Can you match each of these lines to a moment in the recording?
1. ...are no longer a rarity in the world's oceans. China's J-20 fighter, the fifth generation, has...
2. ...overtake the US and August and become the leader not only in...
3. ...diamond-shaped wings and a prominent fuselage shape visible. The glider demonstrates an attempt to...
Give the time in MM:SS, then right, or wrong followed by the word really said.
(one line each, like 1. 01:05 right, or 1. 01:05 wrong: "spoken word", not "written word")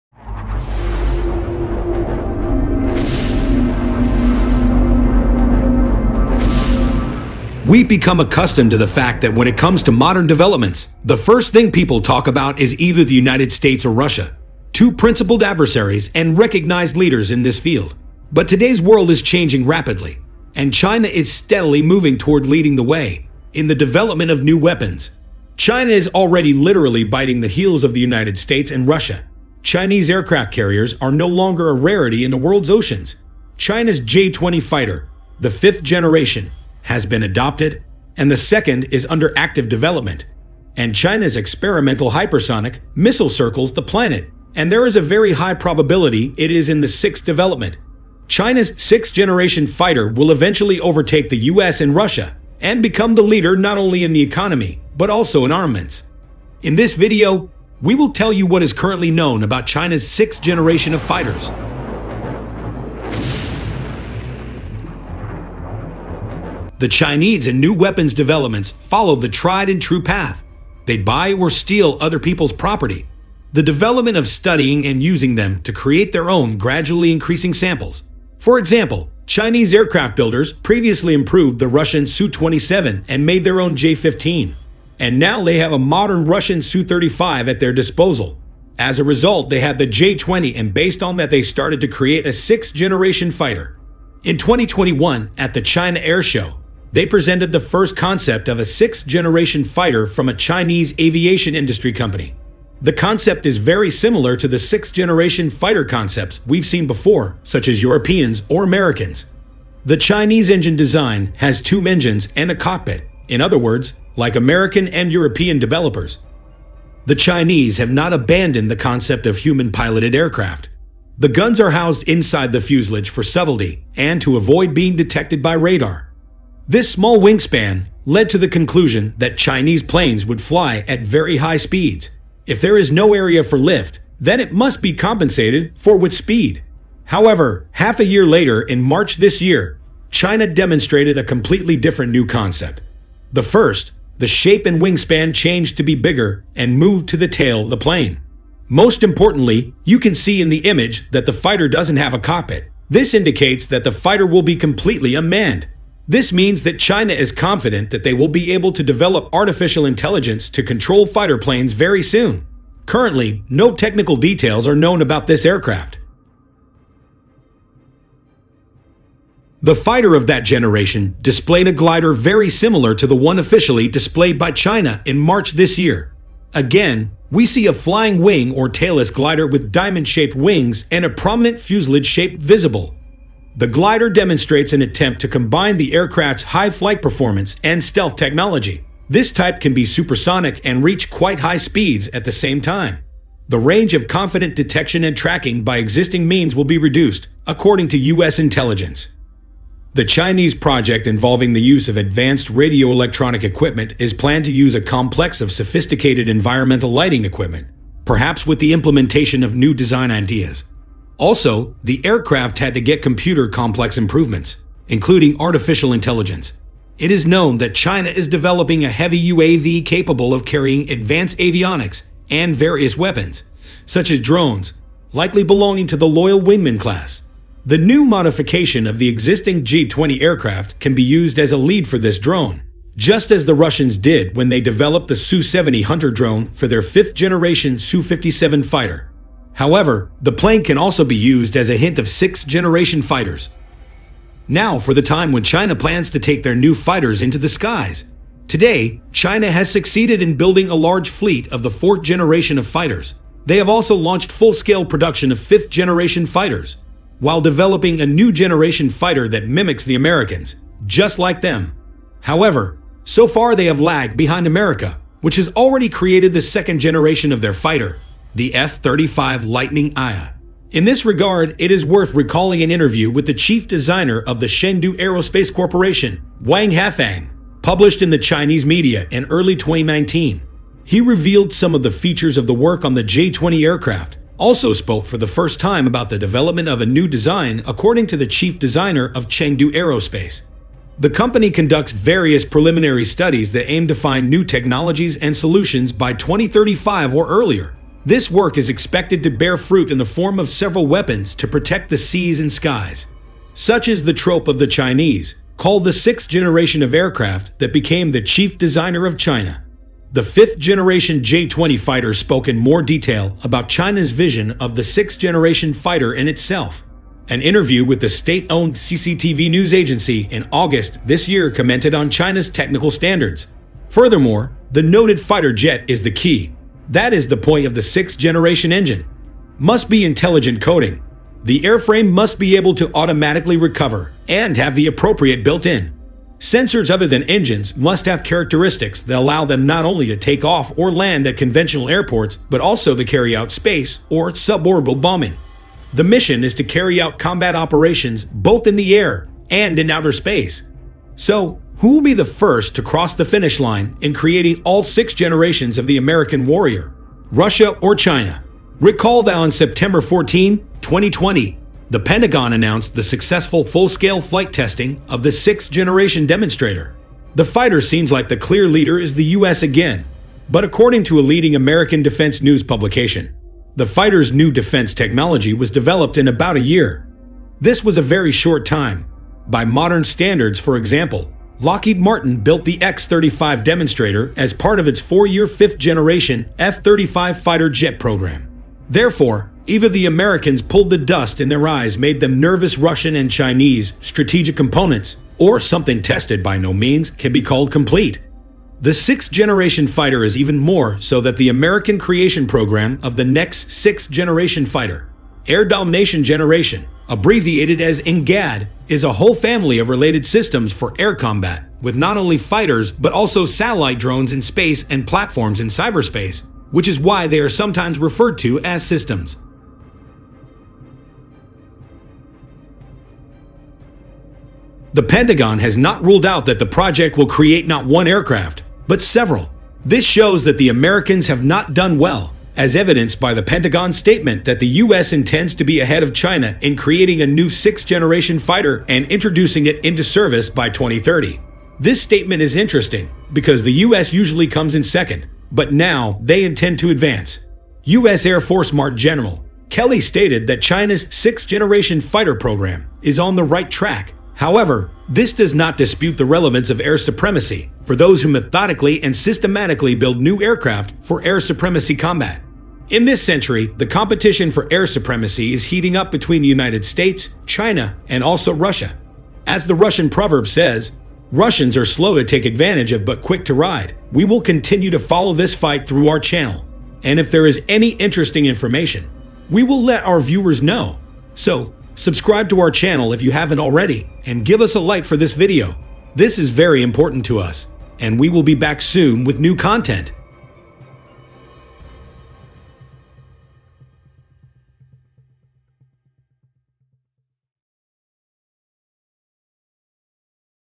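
1. 00:31 right
2. 00:50 wrong: "Russia", not "August"
3. 02:59 right.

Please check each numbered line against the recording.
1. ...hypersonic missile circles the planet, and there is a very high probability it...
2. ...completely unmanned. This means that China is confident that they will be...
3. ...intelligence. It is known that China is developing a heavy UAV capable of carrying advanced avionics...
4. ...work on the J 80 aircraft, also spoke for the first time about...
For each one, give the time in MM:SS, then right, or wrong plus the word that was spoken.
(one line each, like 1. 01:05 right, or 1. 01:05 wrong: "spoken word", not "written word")
1. 00:42 right
2. 02:34 right
3. 03:35 right
4. 04:42 wrong: "20", not "80".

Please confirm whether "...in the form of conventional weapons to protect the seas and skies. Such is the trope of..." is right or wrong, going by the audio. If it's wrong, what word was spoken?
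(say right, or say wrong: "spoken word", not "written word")
wrong: "several", not "conventional".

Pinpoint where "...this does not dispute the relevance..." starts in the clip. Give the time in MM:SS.
07:35.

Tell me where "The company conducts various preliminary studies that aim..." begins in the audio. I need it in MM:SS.
04:50.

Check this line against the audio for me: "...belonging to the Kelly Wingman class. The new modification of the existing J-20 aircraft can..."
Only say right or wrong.
wrong.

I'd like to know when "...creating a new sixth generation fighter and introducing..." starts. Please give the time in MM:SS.
07:16.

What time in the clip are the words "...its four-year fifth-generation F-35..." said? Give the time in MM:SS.
06:24.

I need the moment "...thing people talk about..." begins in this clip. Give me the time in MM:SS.
00:11.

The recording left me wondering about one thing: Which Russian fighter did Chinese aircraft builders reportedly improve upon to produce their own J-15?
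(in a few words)
Su-27.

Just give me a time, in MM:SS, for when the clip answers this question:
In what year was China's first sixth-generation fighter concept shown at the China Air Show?
01:34.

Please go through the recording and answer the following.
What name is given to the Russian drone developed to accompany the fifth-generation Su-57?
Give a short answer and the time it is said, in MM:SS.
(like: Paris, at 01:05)
Su-70 Hunter, at 03:55.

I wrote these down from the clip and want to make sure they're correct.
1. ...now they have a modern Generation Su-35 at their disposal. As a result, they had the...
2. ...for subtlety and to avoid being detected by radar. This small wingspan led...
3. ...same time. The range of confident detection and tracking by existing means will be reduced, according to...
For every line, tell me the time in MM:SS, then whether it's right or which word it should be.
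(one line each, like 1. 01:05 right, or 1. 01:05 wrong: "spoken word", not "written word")
1. 01:25 wrong: "Russian", not "Generation"
2. 02:03 right
3. 03:12 right.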